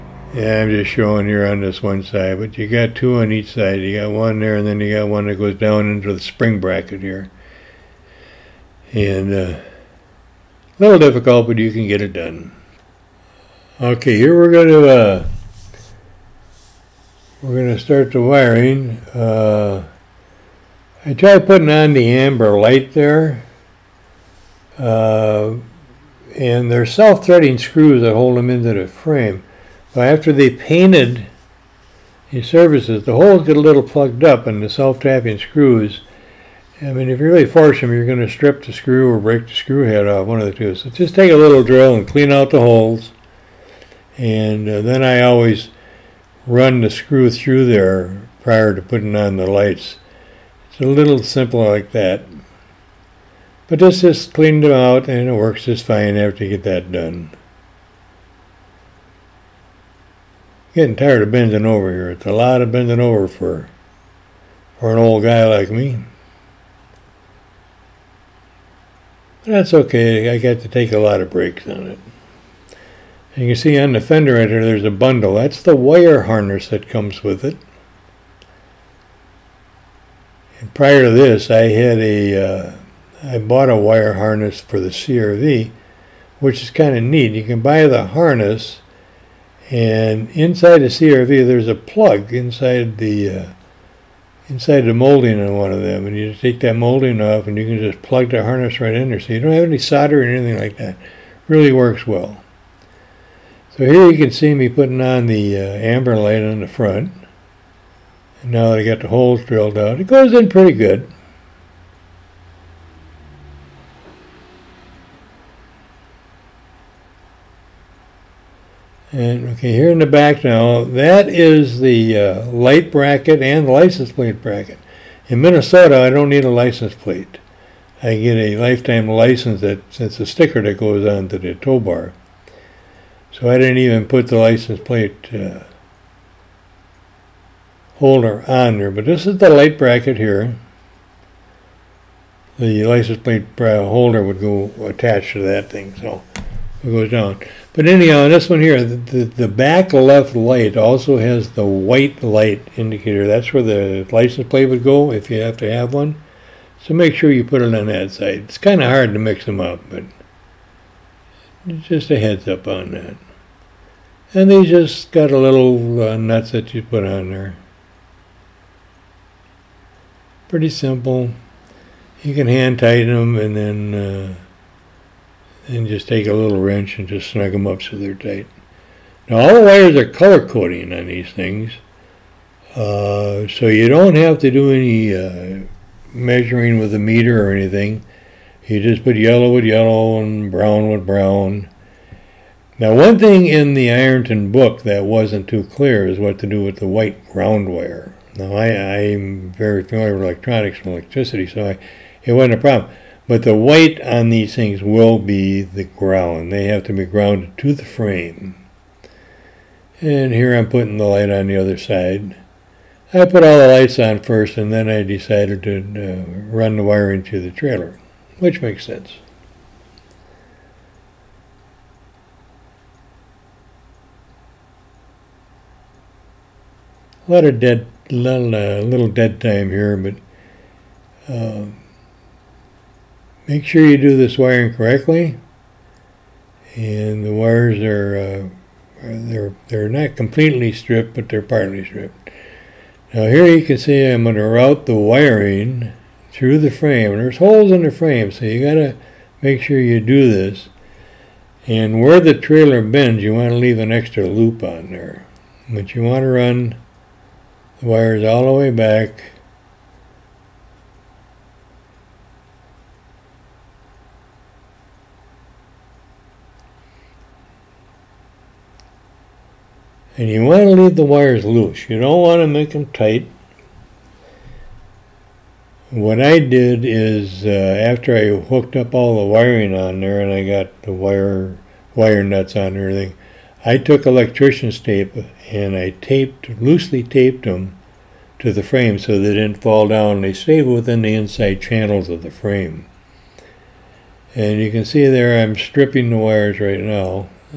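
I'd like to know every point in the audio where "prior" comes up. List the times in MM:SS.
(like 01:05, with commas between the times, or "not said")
00:48, 01:20.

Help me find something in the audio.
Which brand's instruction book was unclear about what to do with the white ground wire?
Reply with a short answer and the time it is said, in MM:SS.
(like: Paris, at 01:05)
Ironton, at 03:13.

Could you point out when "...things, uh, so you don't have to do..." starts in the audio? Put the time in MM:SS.
03:01.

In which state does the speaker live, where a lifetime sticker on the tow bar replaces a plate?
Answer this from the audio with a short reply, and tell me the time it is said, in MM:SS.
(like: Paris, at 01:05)
Minnesota, at 02:05.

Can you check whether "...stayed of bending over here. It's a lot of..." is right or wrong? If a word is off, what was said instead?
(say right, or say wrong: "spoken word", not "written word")
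wrong: "tired", not "stayed".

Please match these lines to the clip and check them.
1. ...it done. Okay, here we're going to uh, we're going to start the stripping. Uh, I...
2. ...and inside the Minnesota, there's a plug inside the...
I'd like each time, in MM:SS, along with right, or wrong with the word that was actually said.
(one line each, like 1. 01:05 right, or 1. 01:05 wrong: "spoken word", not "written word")
1. 00:12 wrong: "wiring", not "stripping"
2. 01:29 wrong: "CRV", not "Minnesota".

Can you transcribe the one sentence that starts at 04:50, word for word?
They stayed within the inside channels of the frame.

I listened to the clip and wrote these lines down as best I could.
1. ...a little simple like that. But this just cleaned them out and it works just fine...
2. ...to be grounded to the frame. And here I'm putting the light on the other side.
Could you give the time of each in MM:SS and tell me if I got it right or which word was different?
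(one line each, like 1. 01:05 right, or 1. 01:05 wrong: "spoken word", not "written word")
1. 00:50 right
2. 03:26 right.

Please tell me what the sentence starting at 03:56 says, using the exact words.
And the wires are uh, they're they're not completely stripped, but they're partly stripped.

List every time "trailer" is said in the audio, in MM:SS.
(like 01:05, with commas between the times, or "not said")
03:37, 04:12.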